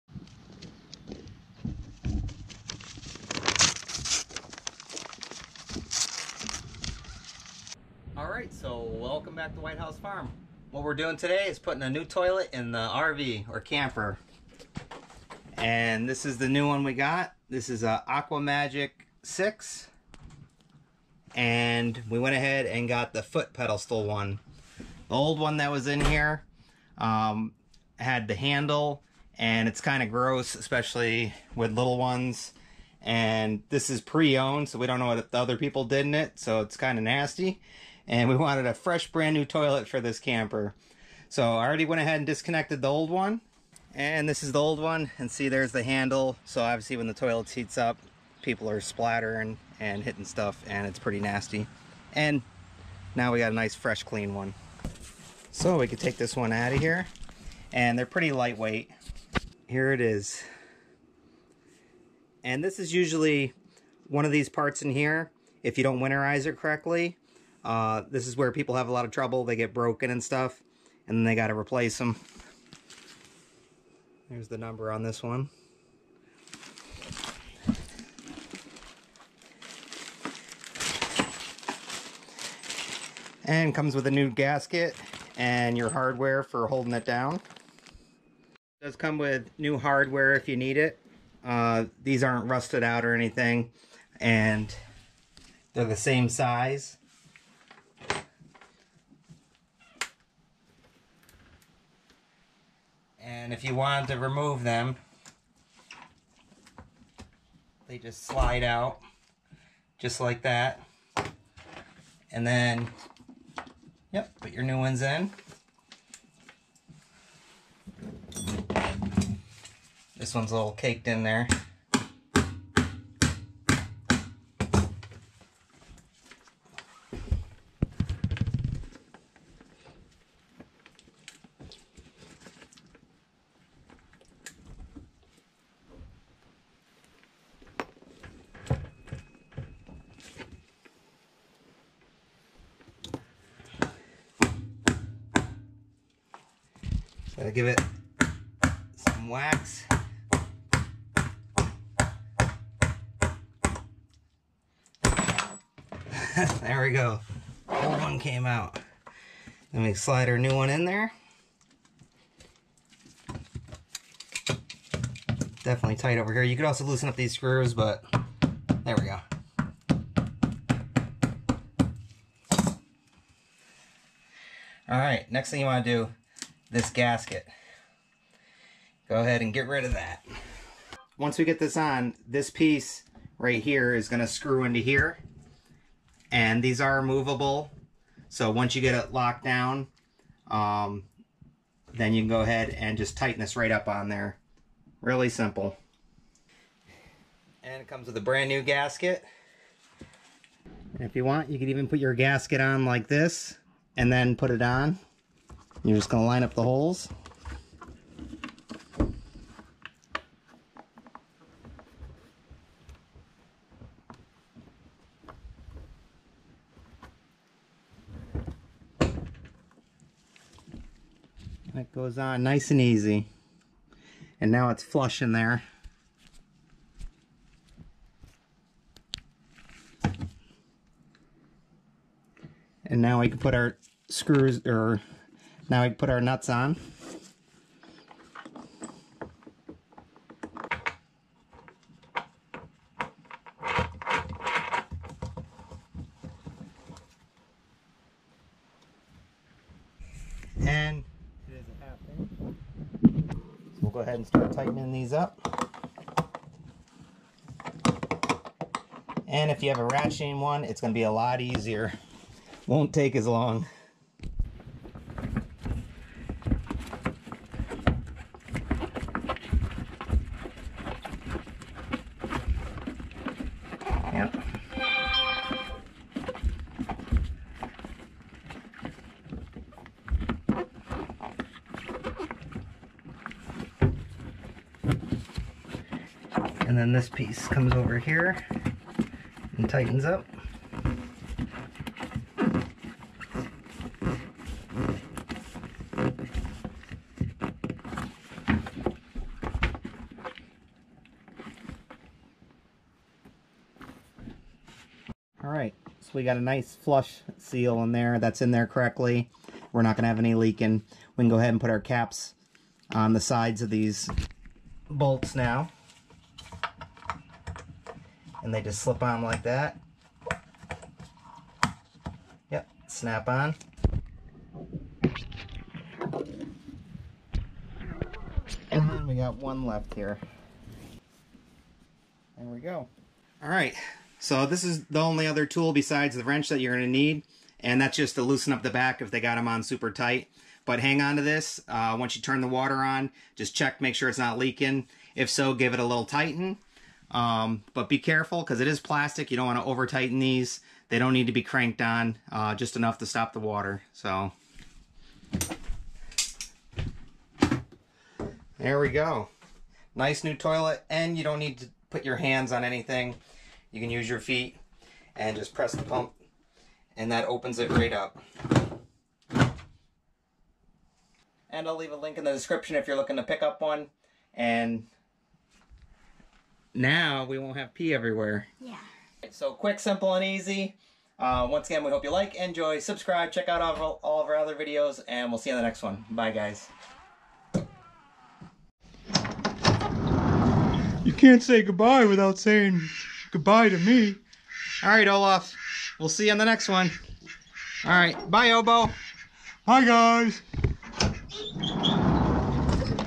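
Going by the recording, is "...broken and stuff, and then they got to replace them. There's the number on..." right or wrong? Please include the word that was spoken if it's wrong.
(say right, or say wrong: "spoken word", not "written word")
right.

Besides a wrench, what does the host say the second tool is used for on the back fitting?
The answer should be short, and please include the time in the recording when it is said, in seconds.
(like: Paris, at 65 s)
loosen up the back, at 338 s.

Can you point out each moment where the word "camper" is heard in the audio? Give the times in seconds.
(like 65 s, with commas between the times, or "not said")
13 s, 40 s.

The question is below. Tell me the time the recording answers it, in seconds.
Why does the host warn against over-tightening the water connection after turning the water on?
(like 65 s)
348 s.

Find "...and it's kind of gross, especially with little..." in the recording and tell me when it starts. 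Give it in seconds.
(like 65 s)
29 s.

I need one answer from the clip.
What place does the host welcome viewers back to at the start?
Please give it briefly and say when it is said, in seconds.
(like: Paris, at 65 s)
Whitehouse Farm, at 9 s.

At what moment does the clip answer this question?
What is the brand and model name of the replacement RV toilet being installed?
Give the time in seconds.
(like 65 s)
18 s.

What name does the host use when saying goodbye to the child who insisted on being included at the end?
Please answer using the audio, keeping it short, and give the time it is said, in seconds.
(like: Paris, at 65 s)
Olaf, at 395 s.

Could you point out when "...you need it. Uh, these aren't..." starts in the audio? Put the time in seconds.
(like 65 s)
90 s.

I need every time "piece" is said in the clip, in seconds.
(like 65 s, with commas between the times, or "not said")
182 s, 287 s.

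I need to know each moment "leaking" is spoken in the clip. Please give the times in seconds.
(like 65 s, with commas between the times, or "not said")
310 s, 344 s.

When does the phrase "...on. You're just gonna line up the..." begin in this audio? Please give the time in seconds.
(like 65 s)
204 s.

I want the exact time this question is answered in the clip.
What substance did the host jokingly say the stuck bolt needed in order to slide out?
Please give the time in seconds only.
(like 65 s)
149 s.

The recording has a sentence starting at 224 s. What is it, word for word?
And now it's flush in there.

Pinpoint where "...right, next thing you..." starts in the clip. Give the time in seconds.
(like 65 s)
174 s.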